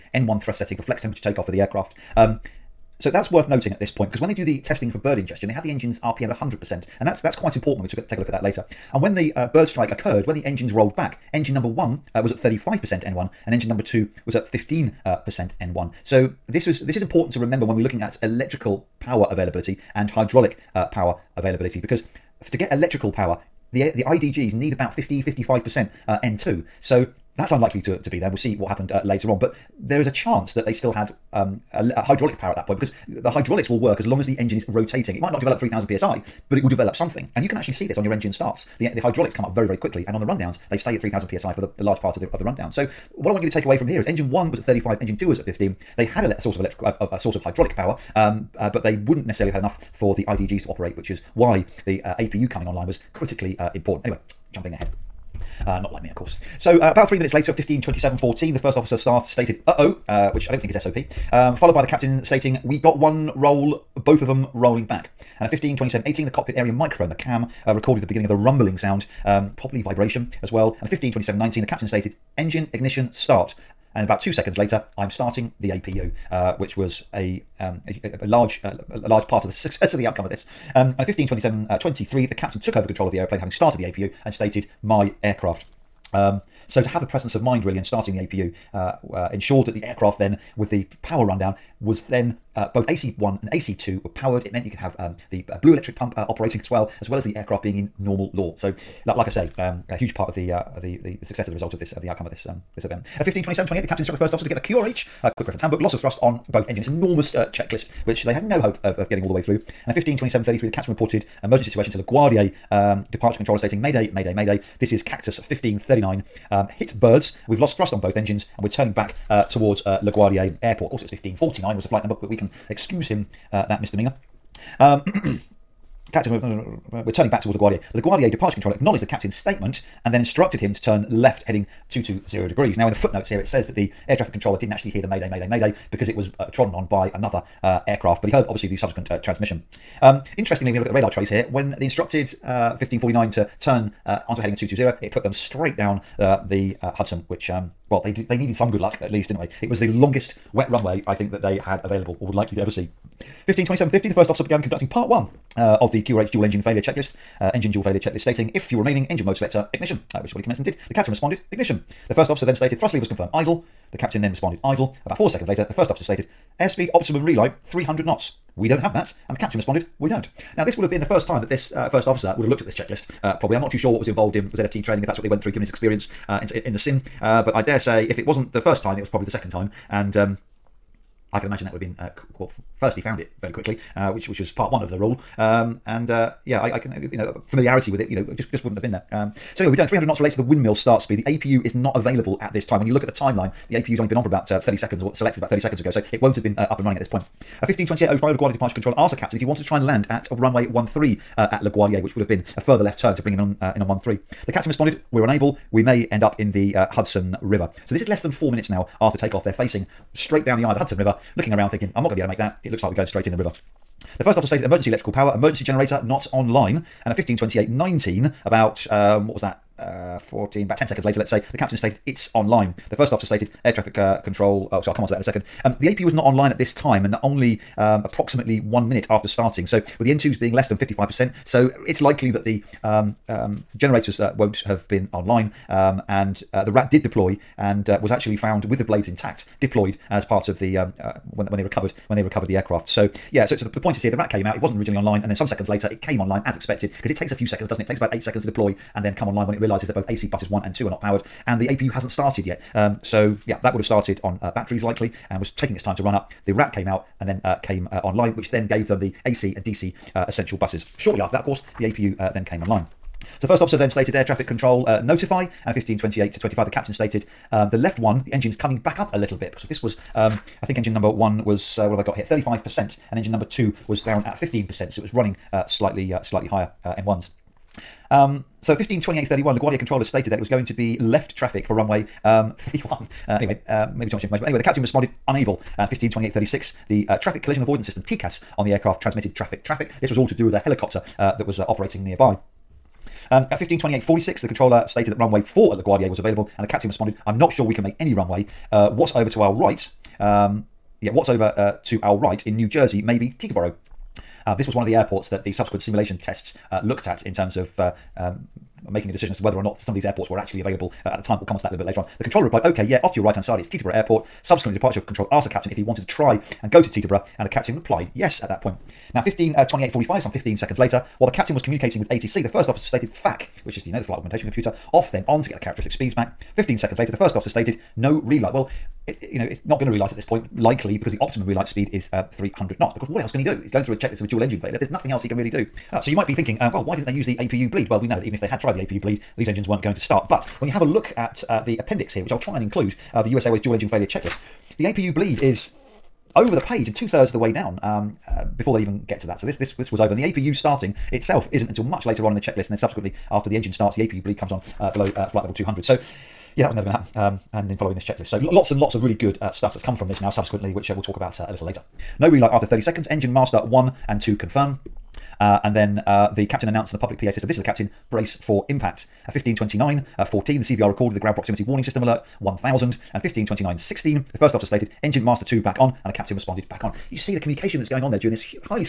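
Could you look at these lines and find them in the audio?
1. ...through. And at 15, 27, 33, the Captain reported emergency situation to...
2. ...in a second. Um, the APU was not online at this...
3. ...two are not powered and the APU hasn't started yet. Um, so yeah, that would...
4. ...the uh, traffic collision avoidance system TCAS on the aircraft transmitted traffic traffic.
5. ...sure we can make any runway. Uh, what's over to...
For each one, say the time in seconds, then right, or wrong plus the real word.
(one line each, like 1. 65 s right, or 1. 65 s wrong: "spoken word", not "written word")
1. 109 s right
2. 225 s right
3. 250 s right
4. 286 s right
5. 297 s right.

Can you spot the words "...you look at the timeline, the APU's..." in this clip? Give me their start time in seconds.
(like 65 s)
192 s.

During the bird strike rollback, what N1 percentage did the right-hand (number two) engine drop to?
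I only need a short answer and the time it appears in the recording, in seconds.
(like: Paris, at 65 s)
15%, at 13 s.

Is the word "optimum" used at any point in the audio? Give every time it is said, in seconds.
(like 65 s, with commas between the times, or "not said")
166 s, 331 s.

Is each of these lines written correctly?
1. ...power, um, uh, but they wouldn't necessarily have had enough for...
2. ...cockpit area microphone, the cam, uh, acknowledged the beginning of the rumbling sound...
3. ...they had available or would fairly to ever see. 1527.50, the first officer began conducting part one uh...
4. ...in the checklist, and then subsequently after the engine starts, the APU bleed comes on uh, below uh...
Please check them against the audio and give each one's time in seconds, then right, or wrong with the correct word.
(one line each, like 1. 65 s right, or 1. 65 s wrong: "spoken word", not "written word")
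1. 47 s right
2. 66 s wrong: "recorded", not "acknowledged"
3. 151 s wrong: "likely", not "fairly"
4. 352 s right.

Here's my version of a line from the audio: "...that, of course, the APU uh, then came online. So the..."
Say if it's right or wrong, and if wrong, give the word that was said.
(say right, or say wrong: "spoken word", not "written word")
right.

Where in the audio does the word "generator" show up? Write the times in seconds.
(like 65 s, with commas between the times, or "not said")
215 s, 233 s.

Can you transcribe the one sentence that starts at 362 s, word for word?
No relight after 30 seconds, engine master 1 and 2 confirm.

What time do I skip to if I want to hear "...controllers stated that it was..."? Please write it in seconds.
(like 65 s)
279 s.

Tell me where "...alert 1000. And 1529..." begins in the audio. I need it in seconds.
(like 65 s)
372 s.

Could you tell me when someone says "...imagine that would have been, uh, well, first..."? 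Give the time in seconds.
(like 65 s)
181 s.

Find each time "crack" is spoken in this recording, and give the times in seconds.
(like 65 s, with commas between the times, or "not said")
not said.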